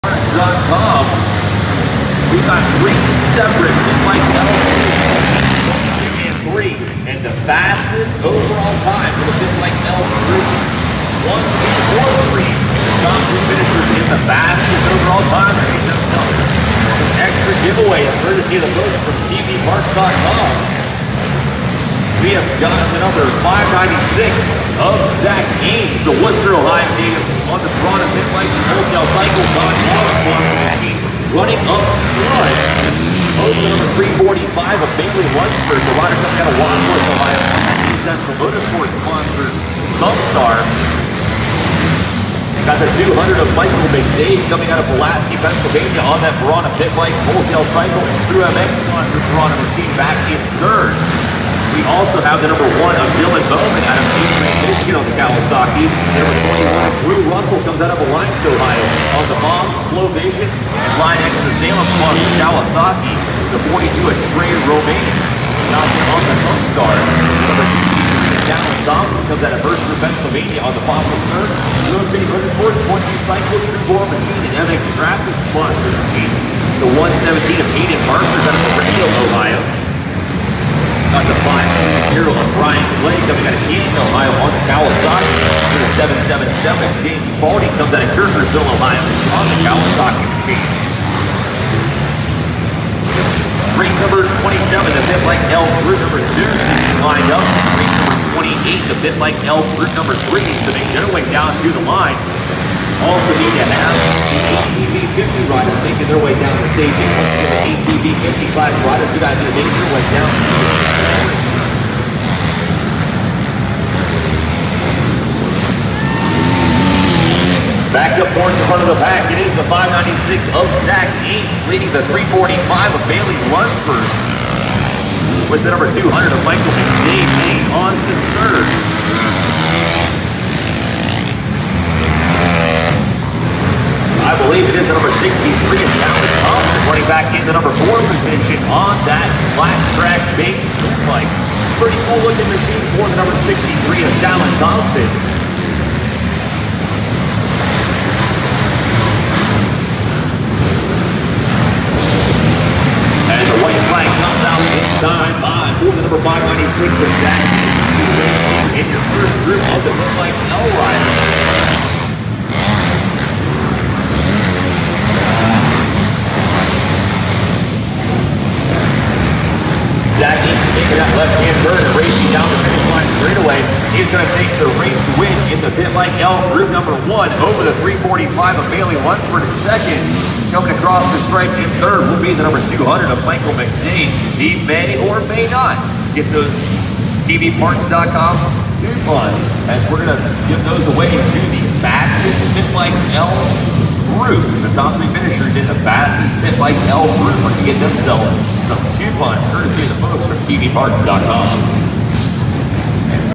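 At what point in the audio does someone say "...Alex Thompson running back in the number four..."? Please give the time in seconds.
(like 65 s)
136 s.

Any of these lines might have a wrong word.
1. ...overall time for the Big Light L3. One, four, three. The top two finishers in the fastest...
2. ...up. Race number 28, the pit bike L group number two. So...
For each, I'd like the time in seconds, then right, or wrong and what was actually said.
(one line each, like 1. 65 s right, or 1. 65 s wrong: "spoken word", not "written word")
1. 8 s right
2. 97 s wrong: "three", not "two".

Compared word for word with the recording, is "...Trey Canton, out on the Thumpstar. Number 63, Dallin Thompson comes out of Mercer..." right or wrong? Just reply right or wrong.
wrong.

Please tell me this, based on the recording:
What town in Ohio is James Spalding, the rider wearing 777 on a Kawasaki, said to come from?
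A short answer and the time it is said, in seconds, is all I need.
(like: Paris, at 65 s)
Kirkersville, Ohio, at 88 s.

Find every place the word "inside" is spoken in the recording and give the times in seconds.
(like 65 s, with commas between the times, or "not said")
154 s.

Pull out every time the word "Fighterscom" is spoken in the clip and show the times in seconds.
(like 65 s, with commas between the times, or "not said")
0 s.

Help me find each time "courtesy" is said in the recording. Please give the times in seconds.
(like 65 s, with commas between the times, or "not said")
18 s, 199 s.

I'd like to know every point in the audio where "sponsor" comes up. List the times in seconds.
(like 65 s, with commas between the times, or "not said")
39 s, 48 s.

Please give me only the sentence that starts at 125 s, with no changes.
With the number 200 of Michael McDade.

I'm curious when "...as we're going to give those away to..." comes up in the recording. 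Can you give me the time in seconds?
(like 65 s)
189 s.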